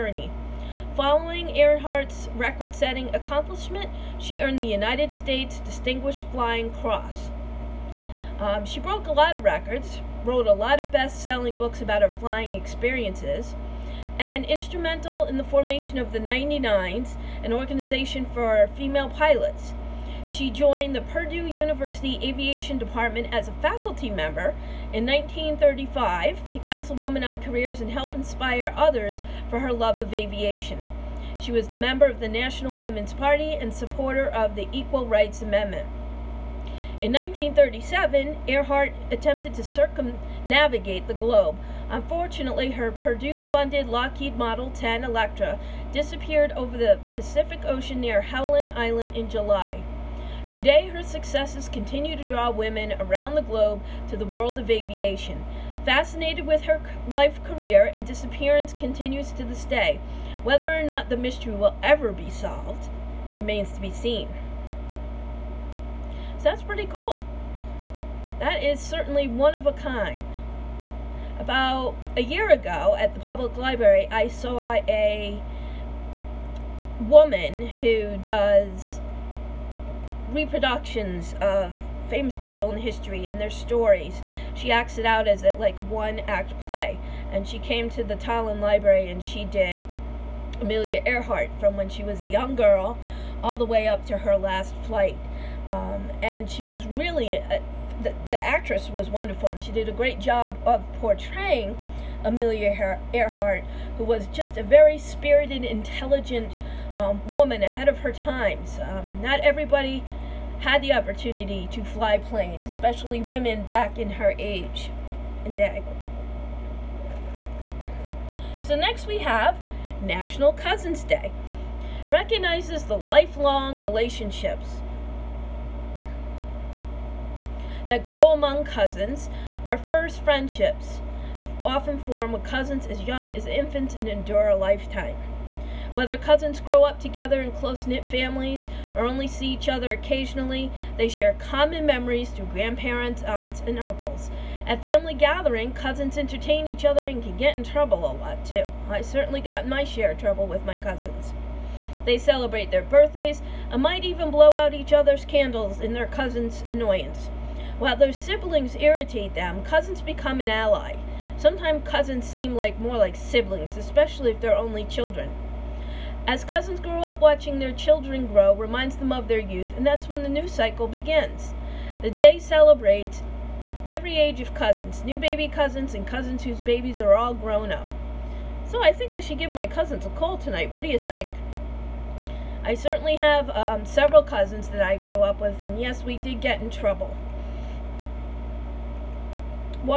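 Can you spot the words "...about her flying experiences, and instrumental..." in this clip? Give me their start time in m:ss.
0:11.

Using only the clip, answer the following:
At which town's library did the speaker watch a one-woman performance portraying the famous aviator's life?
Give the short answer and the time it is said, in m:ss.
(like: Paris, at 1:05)
Tolland, at 1:28.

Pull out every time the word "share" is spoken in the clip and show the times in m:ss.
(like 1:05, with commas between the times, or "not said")
2:21, 2:29.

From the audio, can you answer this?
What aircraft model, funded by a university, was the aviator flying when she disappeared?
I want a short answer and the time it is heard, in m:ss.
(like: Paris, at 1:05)
Lockheed Model 10 Electra, at 0:43.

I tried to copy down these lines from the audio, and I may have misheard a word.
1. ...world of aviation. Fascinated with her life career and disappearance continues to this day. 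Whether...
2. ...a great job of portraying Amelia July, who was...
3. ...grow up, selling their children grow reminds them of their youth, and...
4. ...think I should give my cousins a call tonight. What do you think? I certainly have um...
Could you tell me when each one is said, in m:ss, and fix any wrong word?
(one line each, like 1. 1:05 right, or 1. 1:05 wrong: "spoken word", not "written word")
1. 0:54 right
2. 1:39 wrong: "Earhart", not "July"
3. 2:46 wrong: "watching", not "selling"
4. 2:58 right.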